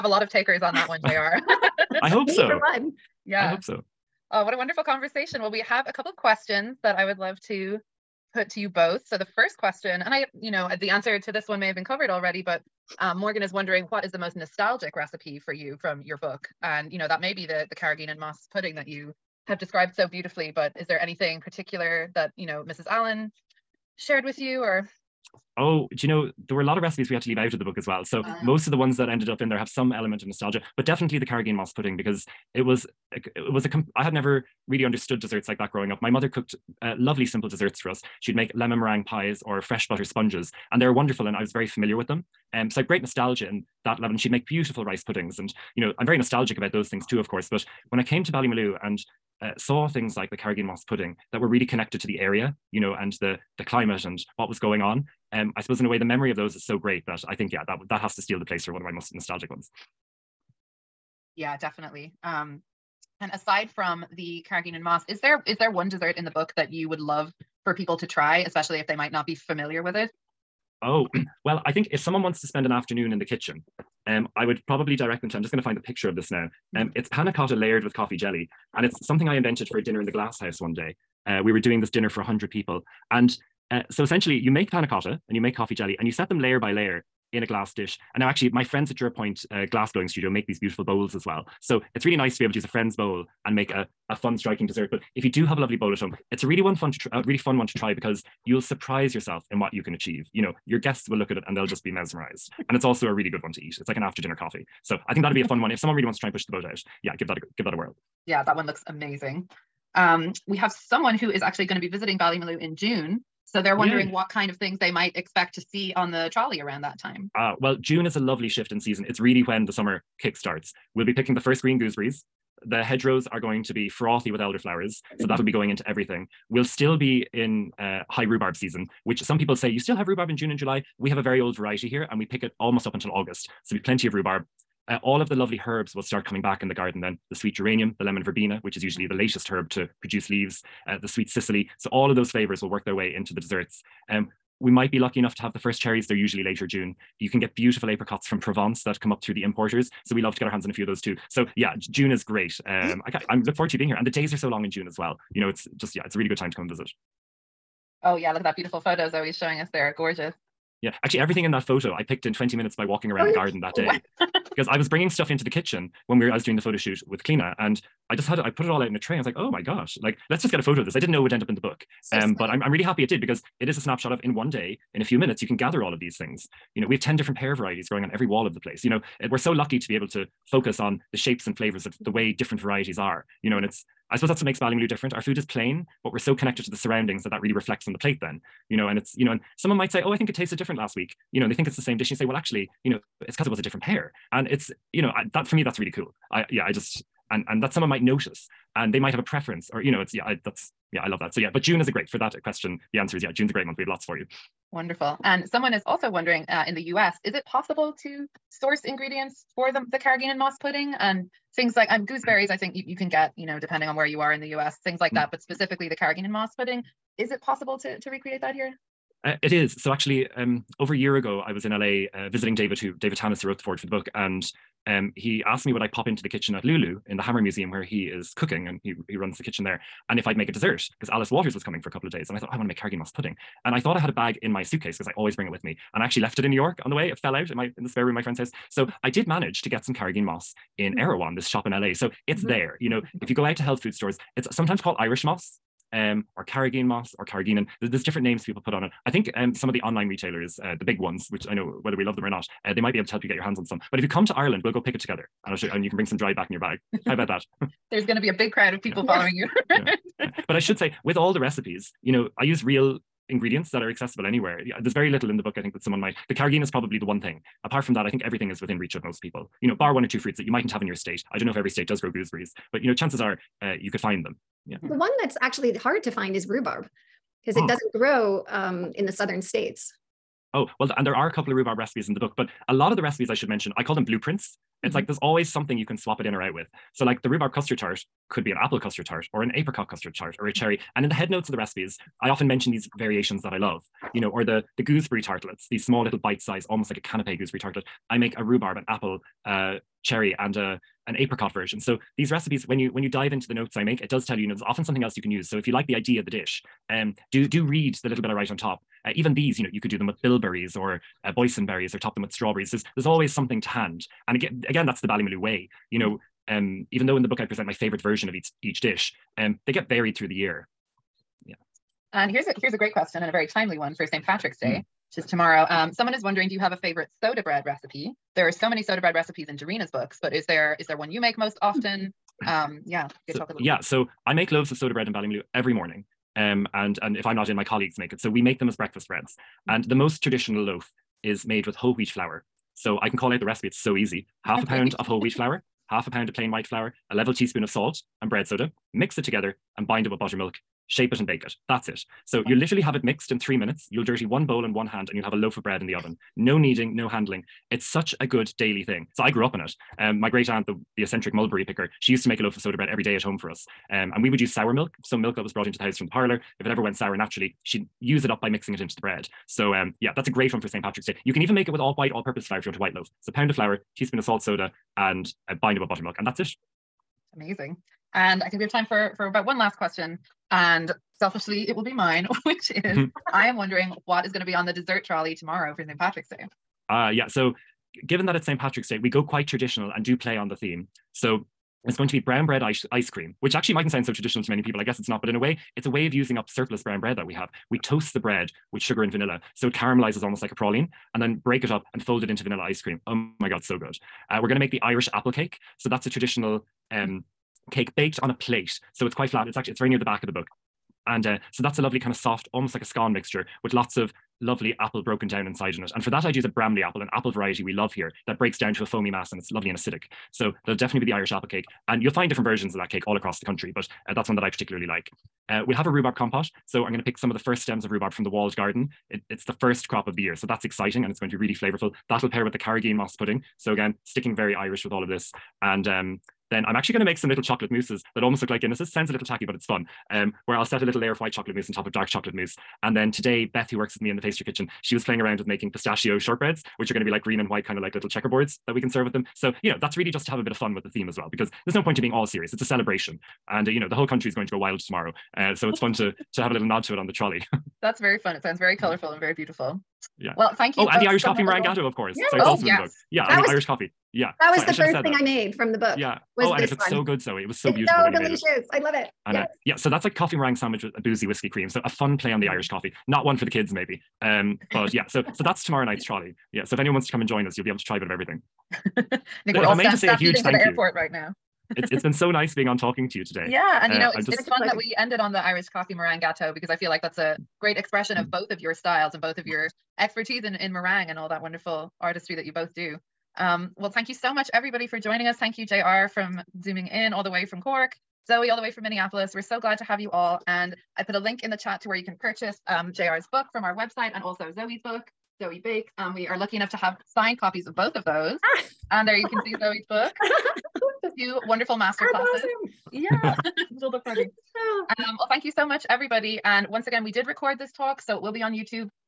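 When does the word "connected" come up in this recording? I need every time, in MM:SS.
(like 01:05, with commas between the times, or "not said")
00:51, 03:06.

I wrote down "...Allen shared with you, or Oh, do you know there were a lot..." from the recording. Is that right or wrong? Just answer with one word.
right.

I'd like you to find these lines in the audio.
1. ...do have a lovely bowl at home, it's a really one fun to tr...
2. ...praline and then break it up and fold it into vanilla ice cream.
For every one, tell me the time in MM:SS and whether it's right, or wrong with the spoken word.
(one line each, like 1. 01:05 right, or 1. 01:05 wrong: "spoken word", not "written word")
1. 01:35 right
2. 06:40 right.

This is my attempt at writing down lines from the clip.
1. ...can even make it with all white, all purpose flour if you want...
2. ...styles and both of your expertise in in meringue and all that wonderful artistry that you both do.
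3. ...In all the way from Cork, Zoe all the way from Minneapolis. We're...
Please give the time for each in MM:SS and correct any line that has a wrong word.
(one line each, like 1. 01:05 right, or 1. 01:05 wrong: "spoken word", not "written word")
1. 06:11 right
2. 08:08 right
3. 08:16 right.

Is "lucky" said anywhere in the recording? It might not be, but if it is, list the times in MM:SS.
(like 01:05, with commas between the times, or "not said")
02:24, 02:59, 08:26.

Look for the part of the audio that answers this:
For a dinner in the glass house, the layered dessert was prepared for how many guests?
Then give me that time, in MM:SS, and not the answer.
01:22.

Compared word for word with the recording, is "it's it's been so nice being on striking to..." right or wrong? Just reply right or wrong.
wrong.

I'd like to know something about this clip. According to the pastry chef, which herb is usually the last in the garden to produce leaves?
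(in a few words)
Lemon verbena.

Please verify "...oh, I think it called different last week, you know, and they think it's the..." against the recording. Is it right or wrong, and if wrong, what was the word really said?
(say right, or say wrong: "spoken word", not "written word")
wrong: "tasted", not "called".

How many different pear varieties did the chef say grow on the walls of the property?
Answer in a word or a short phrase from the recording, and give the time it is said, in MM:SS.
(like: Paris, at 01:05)
10, at 02:56.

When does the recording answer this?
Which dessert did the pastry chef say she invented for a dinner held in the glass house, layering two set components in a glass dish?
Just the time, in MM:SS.
01:17.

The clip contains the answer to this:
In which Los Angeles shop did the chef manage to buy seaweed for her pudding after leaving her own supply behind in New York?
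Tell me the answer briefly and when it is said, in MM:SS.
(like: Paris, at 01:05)
Erewhon, at 04:00.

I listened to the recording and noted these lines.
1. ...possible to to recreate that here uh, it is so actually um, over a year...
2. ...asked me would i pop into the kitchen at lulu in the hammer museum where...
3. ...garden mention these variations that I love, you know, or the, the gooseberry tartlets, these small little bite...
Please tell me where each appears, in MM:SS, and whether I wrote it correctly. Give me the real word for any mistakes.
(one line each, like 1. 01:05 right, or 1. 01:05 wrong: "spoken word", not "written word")
1. 03:37 right
2. 03:45 right
3. 04:52 wrong: "often", not "garden".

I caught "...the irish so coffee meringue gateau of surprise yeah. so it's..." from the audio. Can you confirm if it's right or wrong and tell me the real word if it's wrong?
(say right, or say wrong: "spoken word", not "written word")
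wrong: "course", not "surprise".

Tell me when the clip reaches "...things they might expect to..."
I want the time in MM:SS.
01:54.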